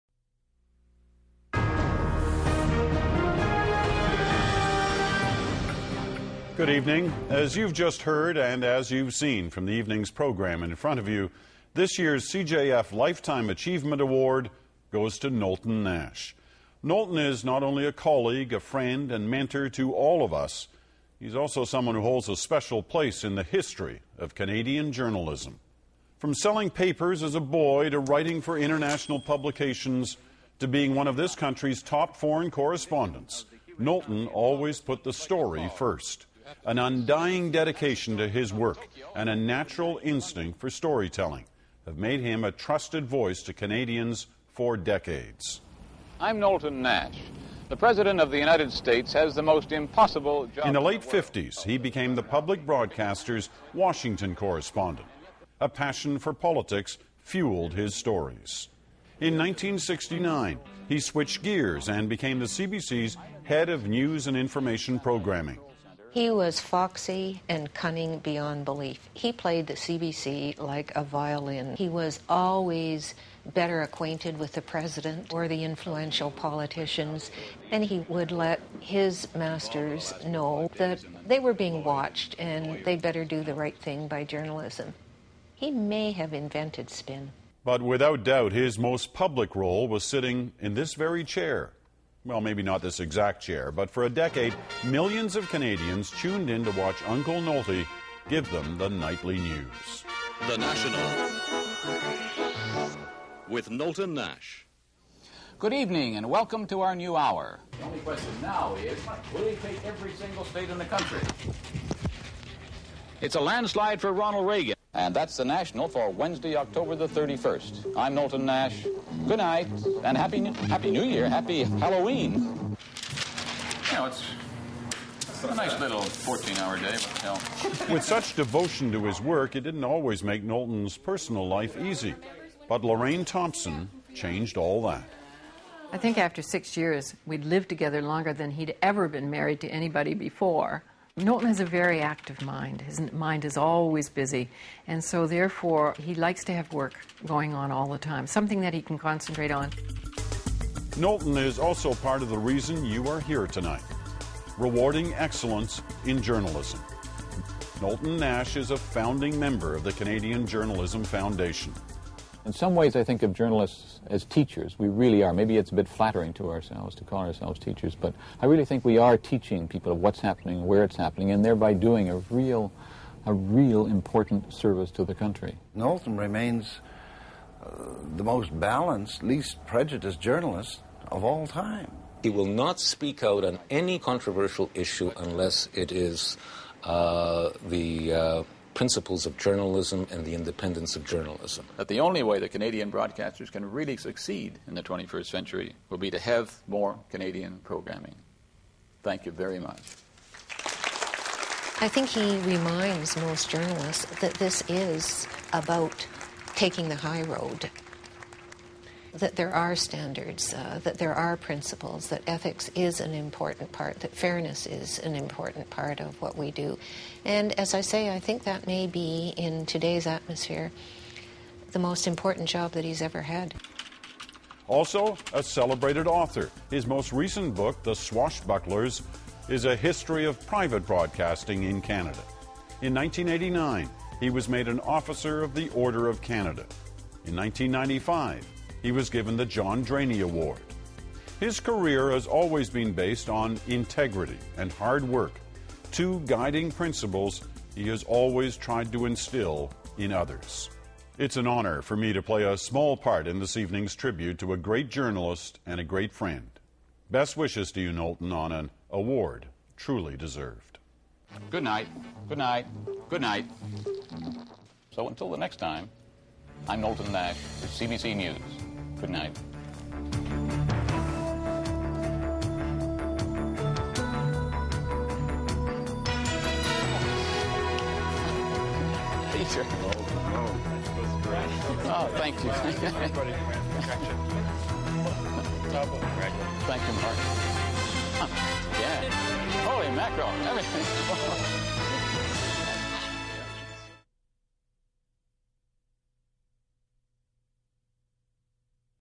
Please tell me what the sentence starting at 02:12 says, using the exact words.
But Lorraine Thomson changed all that.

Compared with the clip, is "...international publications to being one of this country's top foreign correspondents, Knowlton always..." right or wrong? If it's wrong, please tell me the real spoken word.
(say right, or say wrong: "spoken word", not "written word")
right.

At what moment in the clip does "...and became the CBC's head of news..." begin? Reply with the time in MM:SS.
01:01.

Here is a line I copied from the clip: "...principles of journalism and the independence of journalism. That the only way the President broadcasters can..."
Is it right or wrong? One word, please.
wrong.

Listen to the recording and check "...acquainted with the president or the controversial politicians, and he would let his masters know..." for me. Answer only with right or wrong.
wrong.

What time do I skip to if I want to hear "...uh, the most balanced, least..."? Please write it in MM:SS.
02:57.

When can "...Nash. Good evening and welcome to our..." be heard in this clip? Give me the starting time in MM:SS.
01:44.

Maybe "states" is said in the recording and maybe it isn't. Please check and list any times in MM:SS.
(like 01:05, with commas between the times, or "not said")
00:48, 01:50.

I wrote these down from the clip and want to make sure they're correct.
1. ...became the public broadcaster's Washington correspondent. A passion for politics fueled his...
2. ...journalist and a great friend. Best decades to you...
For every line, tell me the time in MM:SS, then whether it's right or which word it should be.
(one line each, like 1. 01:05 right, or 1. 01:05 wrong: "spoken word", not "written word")
1. 00:51 right
2. 04:14 wrong: "wishes", not "decades".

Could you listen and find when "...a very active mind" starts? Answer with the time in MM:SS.
02:21.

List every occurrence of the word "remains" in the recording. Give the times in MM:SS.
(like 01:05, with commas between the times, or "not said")
02:56.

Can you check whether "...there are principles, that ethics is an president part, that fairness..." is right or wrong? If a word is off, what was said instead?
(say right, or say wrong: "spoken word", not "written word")
wrong: "important", not "president".